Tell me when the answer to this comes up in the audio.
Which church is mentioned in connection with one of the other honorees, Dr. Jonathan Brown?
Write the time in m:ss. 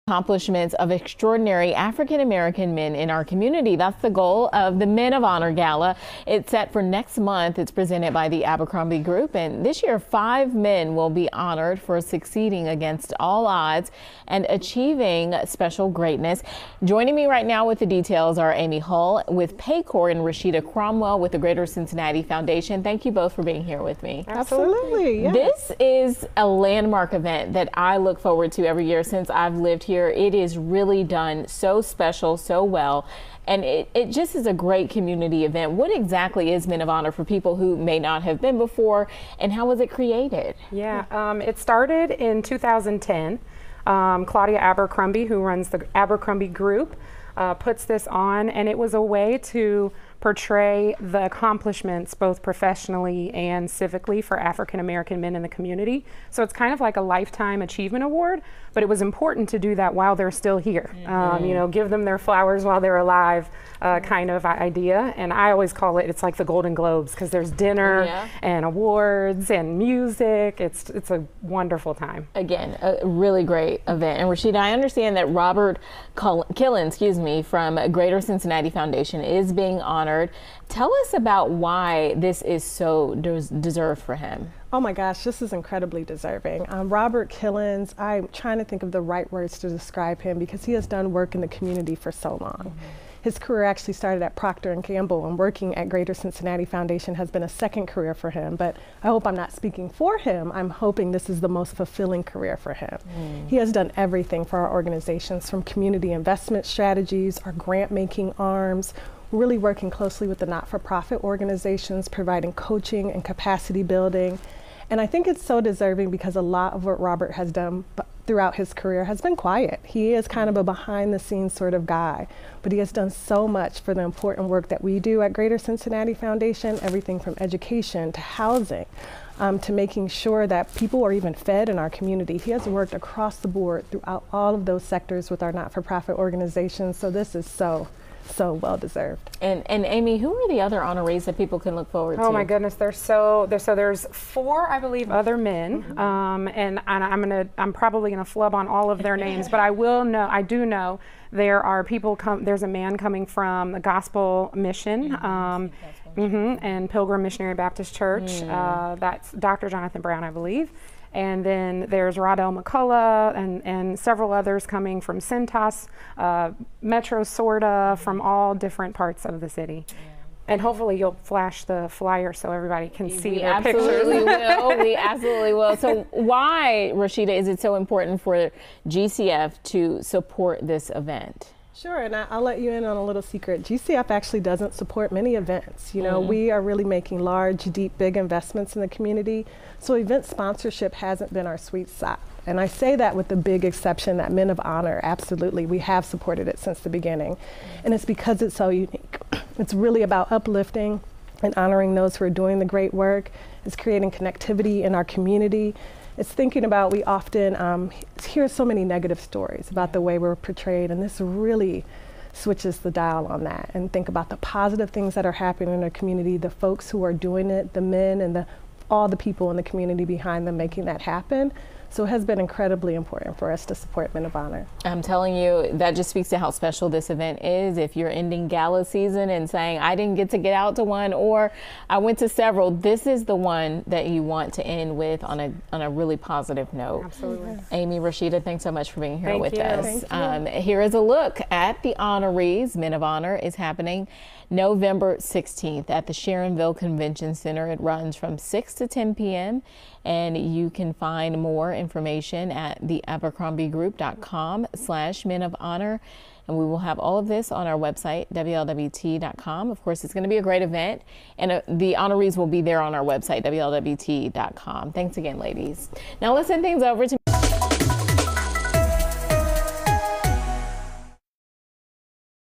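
2:36.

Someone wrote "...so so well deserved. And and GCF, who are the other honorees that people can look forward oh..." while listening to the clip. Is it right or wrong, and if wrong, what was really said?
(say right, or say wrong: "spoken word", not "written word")
wrong: "Amy", not "GCF".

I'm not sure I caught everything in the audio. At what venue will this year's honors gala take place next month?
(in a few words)
Sharonville Convention Center.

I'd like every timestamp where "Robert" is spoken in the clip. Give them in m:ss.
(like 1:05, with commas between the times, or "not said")
1:15, 1:26, 1:56.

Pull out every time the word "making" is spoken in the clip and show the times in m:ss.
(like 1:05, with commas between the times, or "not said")
1:47, 2:09, 3:06, 3:40.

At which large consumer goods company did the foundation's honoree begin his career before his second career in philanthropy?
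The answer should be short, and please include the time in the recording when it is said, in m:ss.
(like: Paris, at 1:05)
Procter and Gamble, at 1:34.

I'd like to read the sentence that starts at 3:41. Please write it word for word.
So it has been incredibly important for us to support Men of Honor.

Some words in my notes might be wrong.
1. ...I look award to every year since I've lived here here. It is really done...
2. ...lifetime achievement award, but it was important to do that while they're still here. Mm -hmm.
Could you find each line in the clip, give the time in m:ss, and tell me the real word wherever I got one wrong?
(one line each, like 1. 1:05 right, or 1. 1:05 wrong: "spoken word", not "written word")
1. 0:27 wrong: "forward", not "award"
2. 0:57 right.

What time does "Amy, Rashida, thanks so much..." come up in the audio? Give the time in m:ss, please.
3:57.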